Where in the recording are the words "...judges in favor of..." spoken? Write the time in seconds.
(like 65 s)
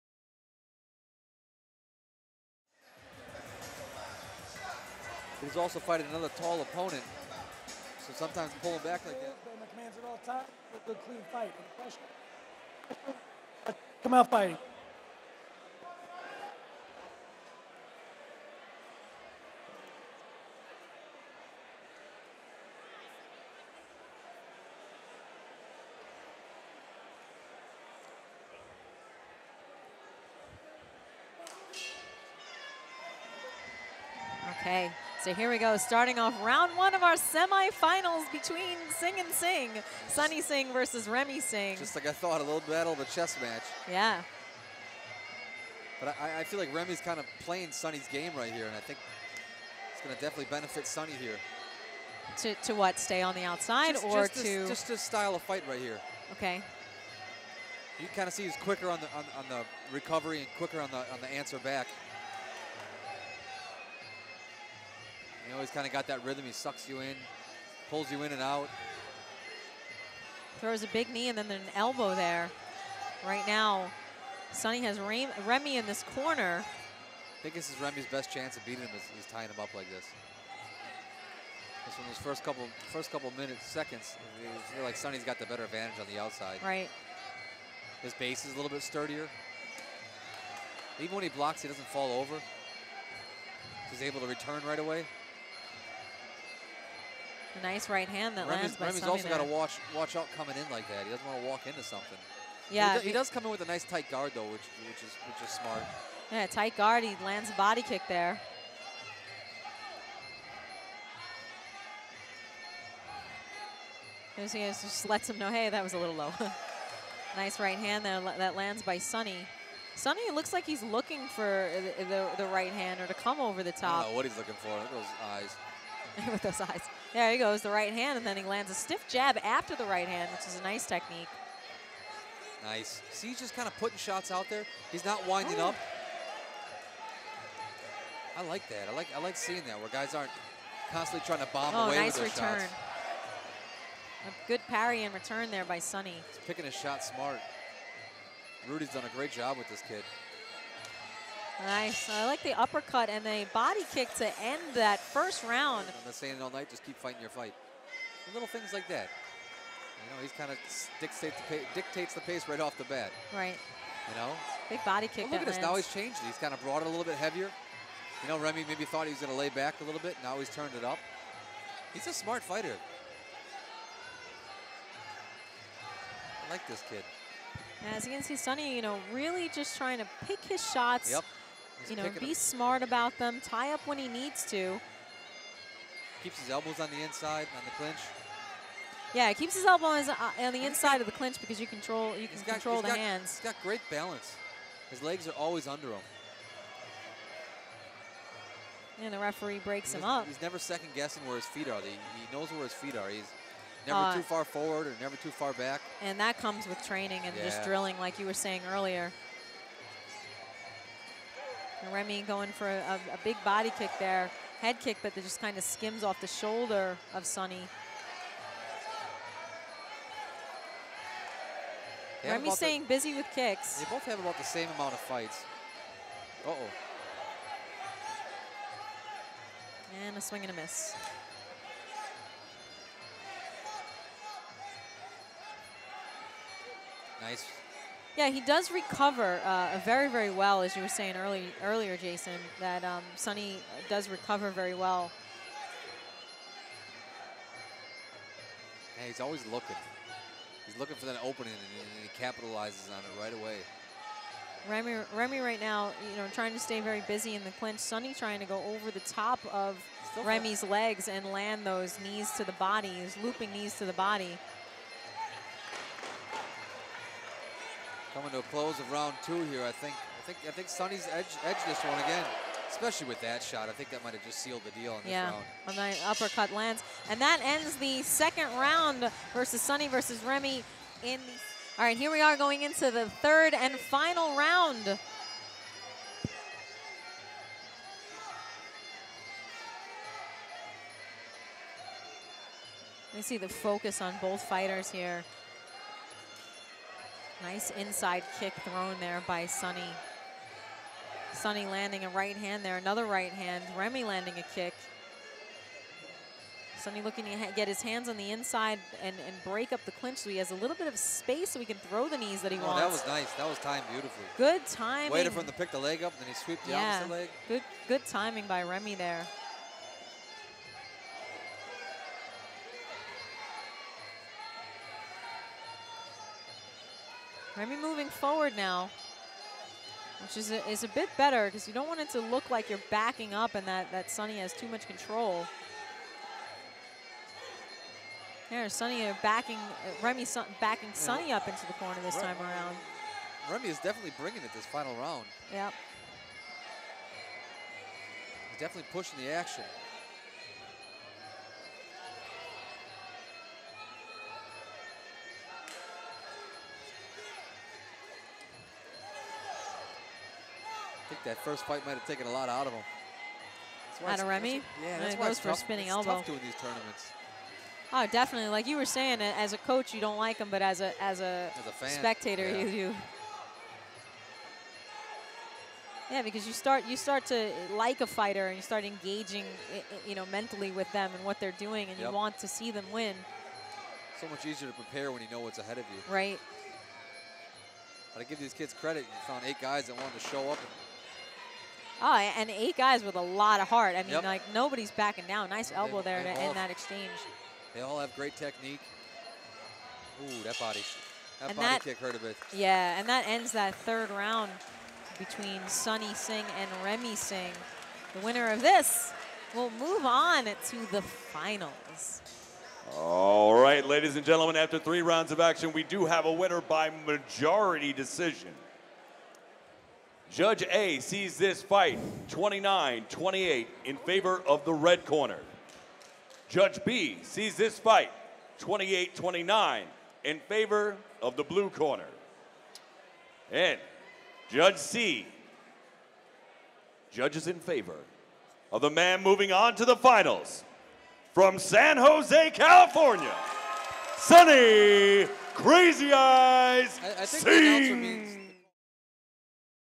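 437 s.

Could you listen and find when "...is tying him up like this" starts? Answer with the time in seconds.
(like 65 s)
79 s.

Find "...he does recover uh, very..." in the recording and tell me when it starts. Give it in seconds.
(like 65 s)
238 s.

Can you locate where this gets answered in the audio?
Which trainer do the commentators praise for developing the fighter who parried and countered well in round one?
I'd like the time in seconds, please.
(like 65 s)
148 s.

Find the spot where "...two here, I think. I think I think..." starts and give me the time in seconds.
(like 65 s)
269 s.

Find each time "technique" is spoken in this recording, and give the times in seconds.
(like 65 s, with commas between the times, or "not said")
130 s, 398 s.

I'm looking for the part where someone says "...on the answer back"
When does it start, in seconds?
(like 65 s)
61 s.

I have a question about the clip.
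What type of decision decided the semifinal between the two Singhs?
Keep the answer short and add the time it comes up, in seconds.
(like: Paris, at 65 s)
Majority decision, at 417 s.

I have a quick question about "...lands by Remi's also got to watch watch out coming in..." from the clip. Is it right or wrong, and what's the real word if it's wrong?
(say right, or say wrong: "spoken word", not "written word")
right.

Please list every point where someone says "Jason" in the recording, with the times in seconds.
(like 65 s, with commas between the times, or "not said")
241 s.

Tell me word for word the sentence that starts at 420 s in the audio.
Judge A sees this fight 29-28 in favor of the red corner.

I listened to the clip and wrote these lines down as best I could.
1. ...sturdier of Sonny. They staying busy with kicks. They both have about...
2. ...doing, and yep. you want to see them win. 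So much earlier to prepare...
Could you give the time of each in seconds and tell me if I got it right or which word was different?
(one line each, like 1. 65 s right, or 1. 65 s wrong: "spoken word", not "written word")
1. 216 s wrong: "shoulder", not "sturdier"
2. 381 s wrong: "easier", not "earlier".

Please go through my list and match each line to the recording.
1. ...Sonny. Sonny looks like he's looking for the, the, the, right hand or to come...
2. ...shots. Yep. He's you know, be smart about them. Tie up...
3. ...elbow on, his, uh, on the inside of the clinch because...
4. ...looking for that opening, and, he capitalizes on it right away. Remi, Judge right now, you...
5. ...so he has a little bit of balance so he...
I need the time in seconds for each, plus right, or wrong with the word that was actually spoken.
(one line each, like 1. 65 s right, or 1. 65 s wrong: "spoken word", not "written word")
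1. 118 s right
2. 180 s right
3. 189 s right
4. 250 s wrong: "Remi", not "Judge"
5. 310 s wrong: "space", not "balance".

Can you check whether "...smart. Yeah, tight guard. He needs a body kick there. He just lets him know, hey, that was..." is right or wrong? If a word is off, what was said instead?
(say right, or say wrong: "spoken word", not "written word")
wrong: "lands", not "needs".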